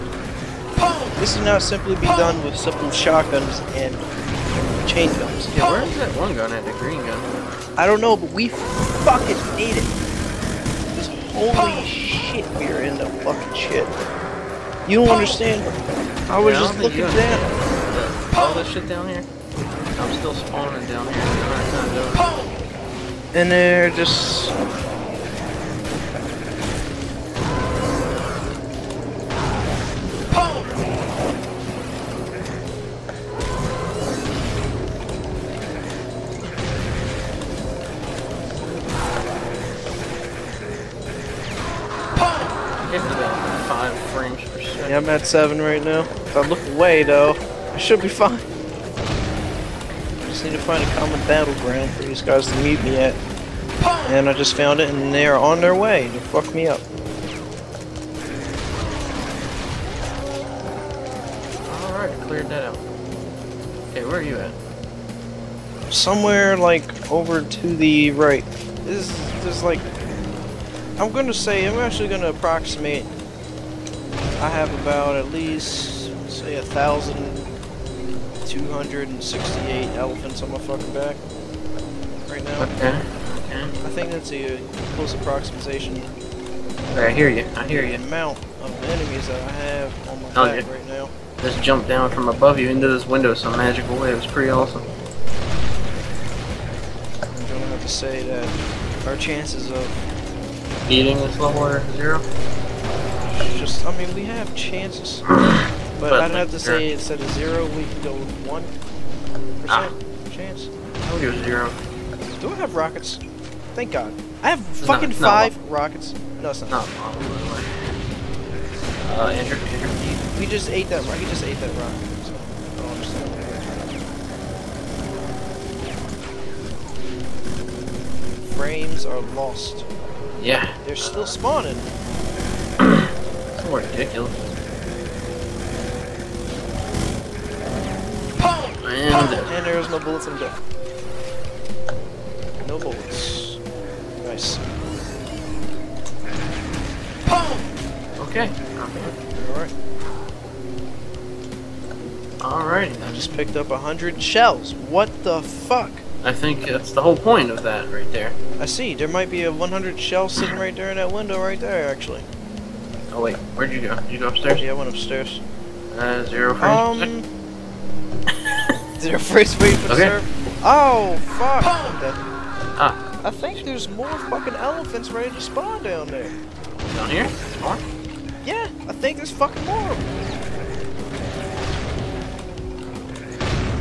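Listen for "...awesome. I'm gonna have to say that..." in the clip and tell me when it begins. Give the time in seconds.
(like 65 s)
94 s.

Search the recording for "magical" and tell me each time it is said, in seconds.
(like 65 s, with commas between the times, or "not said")
93 s.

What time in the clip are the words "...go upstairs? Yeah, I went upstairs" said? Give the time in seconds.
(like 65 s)
164 s.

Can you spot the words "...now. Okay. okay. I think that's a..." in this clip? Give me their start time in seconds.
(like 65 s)
82 s.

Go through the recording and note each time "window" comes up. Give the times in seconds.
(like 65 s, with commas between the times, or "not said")
93 s, 161 s.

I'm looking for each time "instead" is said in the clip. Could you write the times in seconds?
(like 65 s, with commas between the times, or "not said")
106 s.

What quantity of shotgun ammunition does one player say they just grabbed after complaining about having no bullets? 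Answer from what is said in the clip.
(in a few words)
100 shells.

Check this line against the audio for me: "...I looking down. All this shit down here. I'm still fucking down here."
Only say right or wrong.
wrong.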